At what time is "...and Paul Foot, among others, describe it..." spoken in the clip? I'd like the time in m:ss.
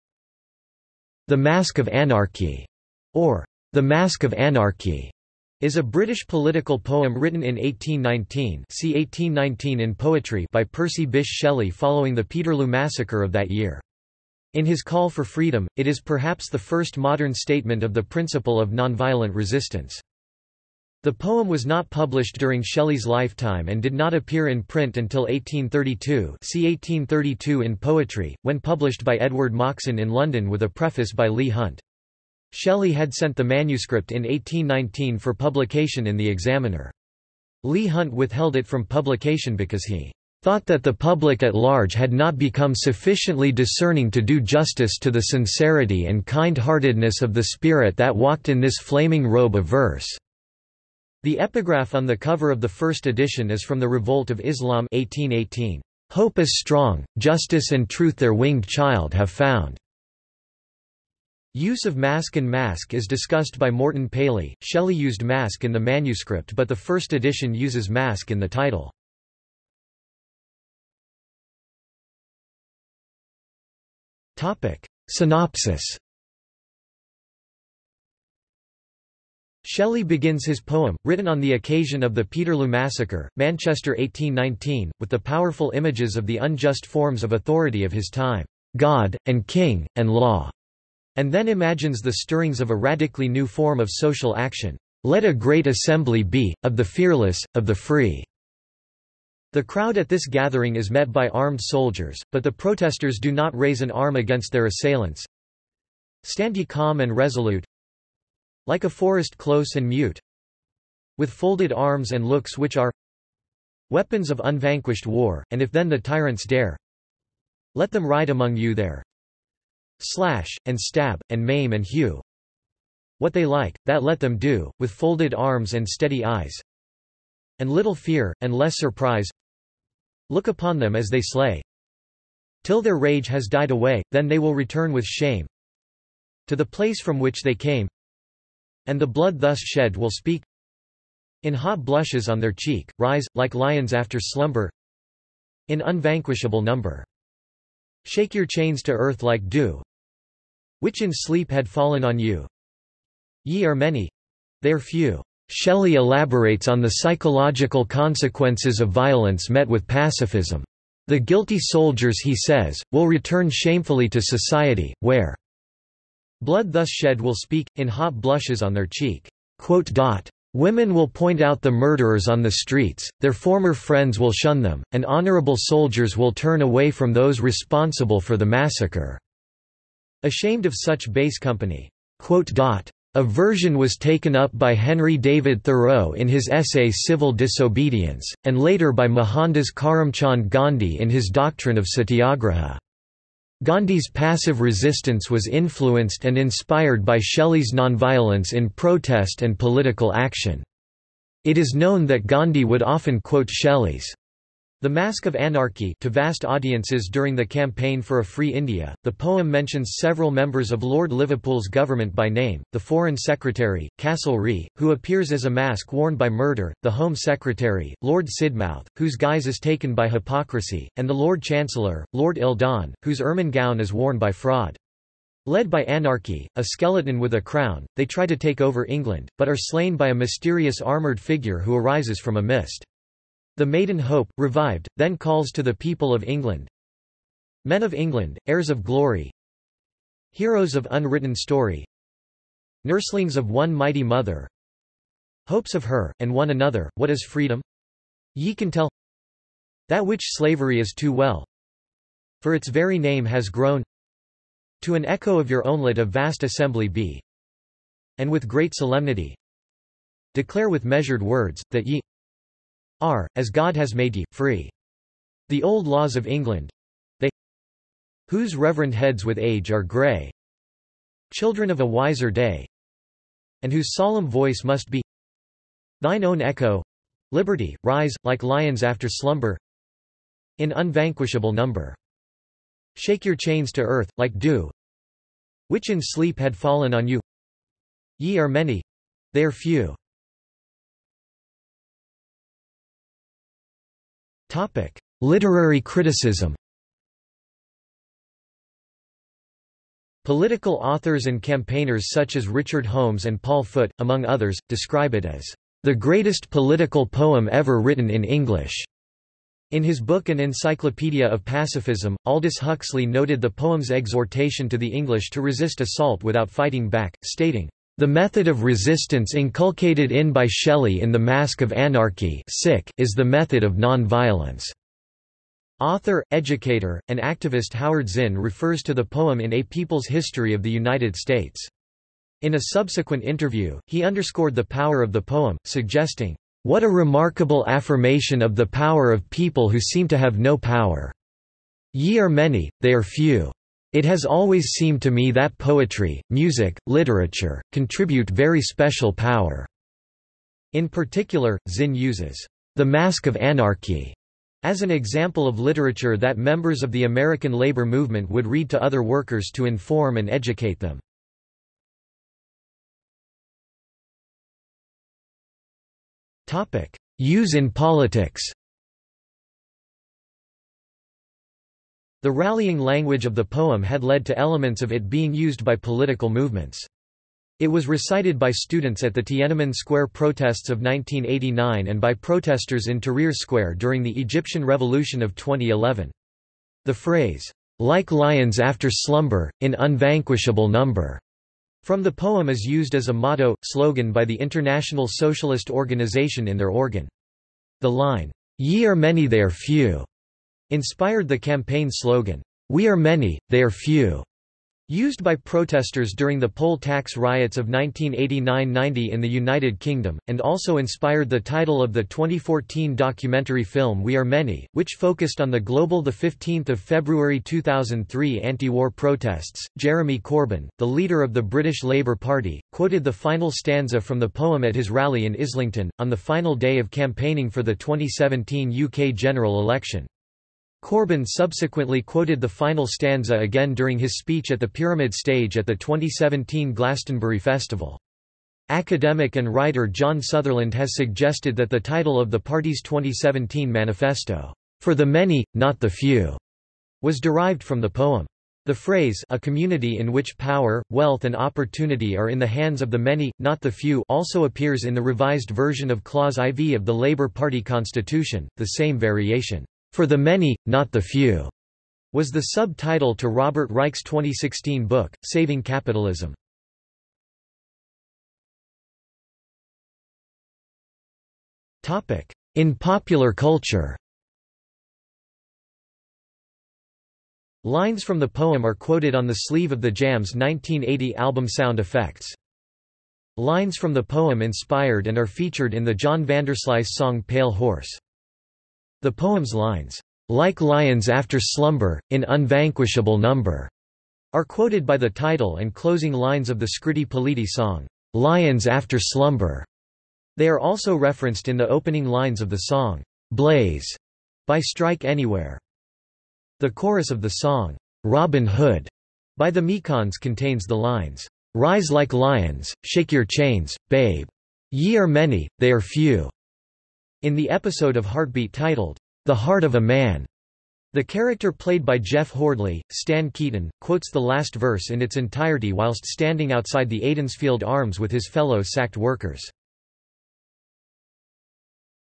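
5:03.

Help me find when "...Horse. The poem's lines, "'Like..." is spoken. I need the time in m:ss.
8:07.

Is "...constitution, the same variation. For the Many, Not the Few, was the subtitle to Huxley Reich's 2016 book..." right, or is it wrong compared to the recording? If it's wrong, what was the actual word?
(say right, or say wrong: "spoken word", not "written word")
wrong: "Robert", not "Huxley".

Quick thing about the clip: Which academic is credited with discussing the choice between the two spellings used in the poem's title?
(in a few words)
Morton Paley.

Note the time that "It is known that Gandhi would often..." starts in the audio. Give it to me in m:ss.
3:21.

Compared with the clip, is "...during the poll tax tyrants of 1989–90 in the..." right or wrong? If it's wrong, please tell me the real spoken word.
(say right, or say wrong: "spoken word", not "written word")
wrong: "riots", not "tyrants".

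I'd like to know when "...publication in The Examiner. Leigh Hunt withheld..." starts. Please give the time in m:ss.
0:35.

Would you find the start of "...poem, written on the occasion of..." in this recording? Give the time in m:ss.
1:20.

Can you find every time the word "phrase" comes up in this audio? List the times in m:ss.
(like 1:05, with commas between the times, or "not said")
6:26, 7:28.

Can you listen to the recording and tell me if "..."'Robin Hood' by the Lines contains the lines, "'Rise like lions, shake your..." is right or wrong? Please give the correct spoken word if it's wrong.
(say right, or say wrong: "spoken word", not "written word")
wrong: "Mekons", not "Lines".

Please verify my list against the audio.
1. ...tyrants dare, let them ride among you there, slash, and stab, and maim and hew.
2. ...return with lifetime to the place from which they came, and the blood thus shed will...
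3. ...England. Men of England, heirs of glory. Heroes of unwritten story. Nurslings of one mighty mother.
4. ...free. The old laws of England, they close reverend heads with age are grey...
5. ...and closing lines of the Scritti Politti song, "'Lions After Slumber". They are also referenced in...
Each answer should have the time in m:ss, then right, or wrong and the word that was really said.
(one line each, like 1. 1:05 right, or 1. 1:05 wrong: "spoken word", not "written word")
1. 1:55 right
2. 2:14 wrong: "shame", not "lifetime"
3. 3:56 right
4. 4:24 wrong: "whose", not "close"
5. 8:15 right.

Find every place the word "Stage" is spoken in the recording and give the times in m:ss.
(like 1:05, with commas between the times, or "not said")
7:15.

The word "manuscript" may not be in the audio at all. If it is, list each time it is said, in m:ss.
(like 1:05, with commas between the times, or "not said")
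0:33, 1:05.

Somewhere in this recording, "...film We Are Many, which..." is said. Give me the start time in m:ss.
6:53.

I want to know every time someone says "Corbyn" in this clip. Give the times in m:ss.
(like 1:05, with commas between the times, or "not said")
7:00, 7:10.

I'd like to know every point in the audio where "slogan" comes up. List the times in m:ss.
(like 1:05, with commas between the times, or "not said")
6:33, 6:41.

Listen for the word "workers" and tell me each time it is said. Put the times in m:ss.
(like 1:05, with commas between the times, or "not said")
5:59, 8:48.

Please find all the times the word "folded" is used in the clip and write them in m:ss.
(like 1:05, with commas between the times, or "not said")
1:51, 2:04.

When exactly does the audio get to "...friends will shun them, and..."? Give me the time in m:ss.
2:53.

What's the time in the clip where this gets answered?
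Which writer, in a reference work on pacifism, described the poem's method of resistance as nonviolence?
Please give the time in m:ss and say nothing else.
5:12.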